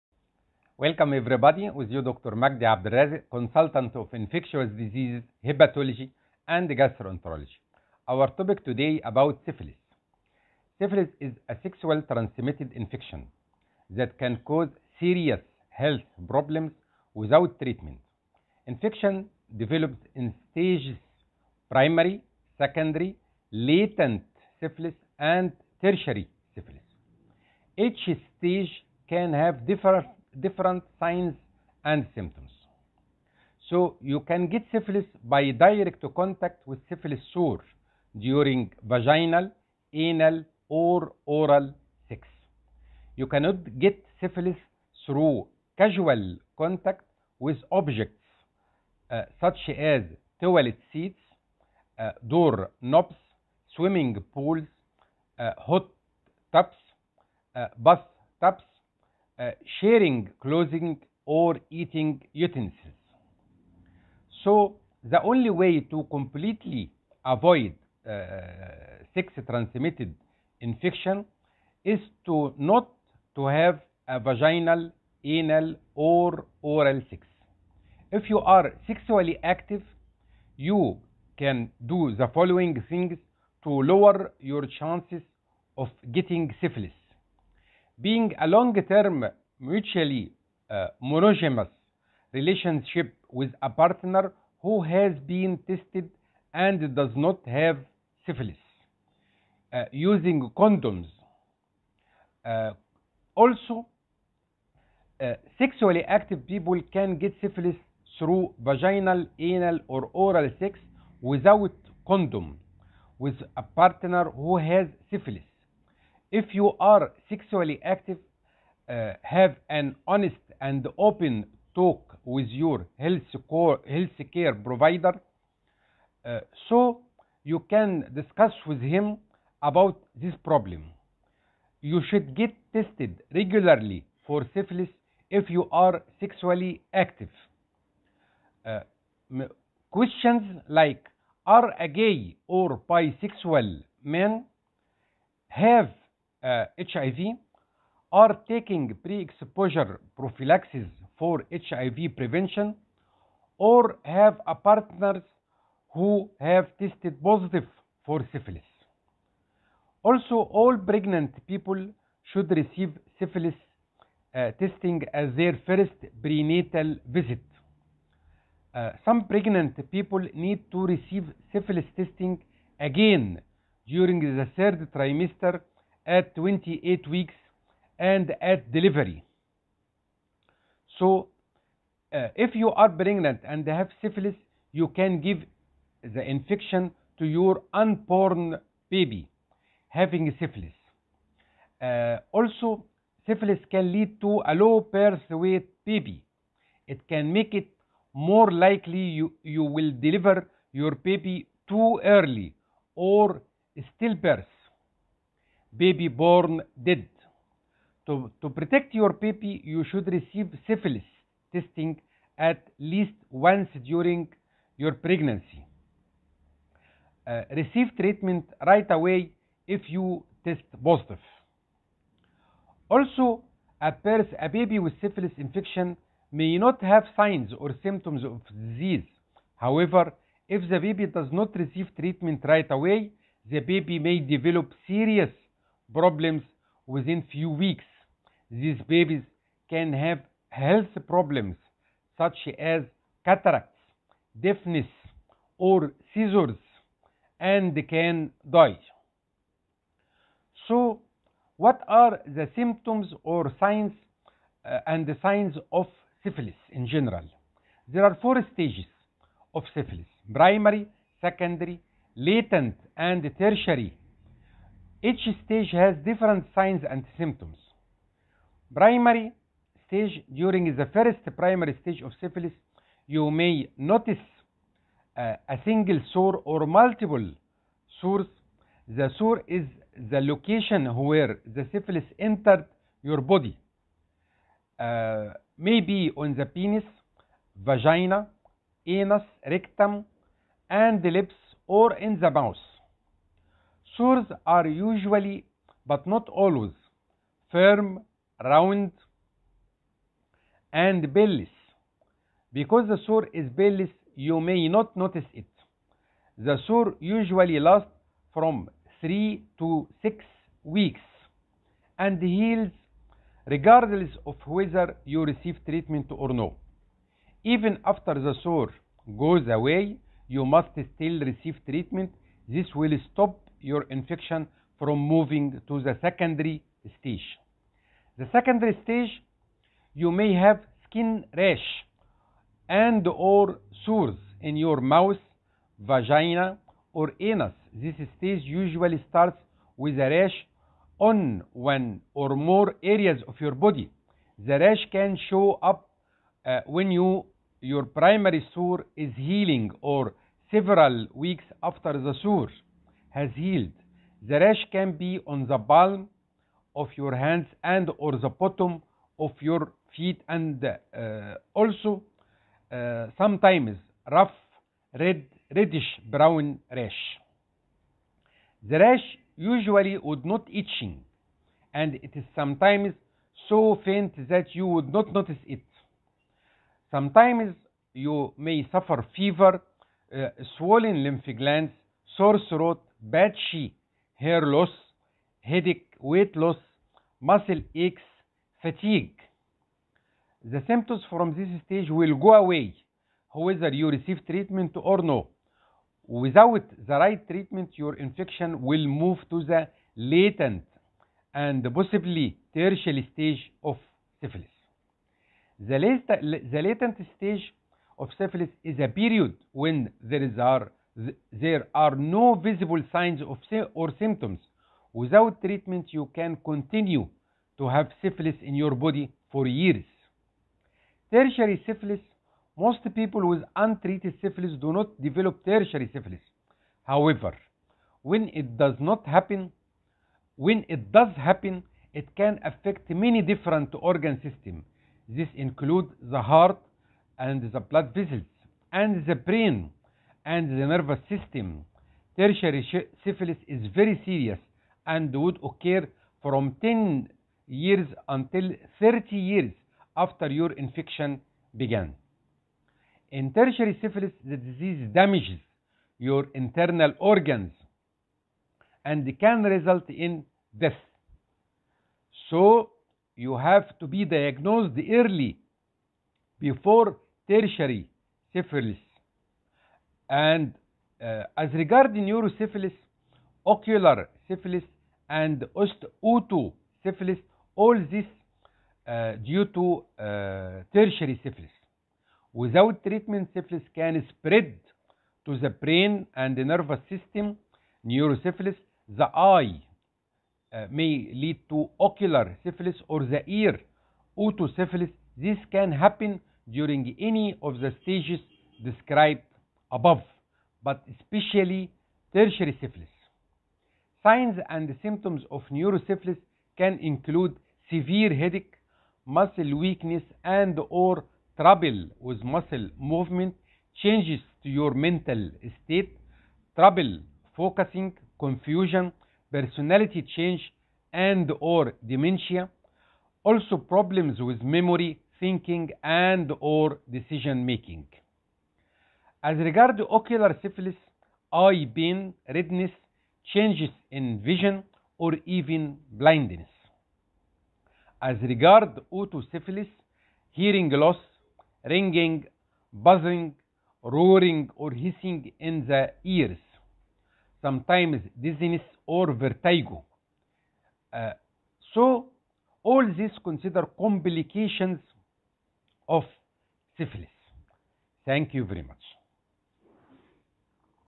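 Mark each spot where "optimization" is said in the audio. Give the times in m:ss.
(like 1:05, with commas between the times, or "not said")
not said.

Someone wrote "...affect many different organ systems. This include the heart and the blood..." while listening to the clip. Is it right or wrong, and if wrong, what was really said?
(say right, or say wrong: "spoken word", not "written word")
right.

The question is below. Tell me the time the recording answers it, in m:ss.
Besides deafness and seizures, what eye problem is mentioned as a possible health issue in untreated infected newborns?
4:03.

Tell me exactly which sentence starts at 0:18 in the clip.
Infection develops in stages primary, secondary, latent syphilis and tertiary syphilis.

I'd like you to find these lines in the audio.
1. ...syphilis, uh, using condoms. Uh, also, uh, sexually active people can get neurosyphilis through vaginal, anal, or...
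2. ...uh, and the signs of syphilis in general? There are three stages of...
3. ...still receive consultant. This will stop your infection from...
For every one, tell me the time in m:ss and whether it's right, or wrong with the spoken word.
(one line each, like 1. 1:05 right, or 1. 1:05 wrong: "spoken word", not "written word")
1. 1:38 wrong: "syphilis", not "neurosyphilis"
2. 4:14 wrong: "four", not "three"
3. 5:20 wrong: "treatment", not "consultant".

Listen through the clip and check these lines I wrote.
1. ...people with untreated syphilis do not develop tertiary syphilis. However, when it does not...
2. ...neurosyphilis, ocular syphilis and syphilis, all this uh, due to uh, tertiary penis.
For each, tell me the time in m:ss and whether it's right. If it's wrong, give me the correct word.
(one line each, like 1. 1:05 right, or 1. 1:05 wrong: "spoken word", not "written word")
1. 7:02 right
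2. 7:52 wrong: "syphilis", not "penis".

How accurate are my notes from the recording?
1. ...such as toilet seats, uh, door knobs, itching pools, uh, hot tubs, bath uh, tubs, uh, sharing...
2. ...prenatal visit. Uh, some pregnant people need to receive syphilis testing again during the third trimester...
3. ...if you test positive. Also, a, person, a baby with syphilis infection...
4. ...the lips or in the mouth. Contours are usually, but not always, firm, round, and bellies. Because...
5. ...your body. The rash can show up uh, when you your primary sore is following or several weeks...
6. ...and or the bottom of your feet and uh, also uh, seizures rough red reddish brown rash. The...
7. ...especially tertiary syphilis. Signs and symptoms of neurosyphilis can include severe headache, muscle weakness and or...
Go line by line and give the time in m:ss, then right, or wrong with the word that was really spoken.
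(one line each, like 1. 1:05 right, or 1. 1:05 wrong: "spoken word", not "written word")
1. 0:49 wrong: "swimming", not "itching"
2. 2:46 right
3. 3:39 right
4. 4:51 right
5. 5:43 wrong: "healing", not "following"
6. 5:57 wrong: "sometimes", not "seizures"
7. 8:20 right.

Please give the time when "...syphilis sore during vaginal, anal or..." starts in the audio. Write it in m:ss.
0:36.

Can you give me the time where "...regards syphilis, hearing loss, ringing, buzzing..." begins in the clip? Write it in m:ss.
8:58.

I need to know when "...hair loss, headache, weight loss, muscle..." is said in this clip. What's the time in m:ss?
6:24.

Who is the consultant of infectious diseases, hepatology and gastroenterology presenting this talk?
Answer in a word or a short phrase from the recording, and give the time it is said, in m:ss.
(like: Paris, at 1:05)
Dr. Magdy Abdel Razek, at 0:02.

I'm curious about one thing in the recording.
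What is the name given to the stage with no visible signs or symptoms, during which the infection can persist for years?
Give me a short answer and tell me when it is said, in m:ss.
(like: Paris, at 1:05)
Latent stage, at 6:46.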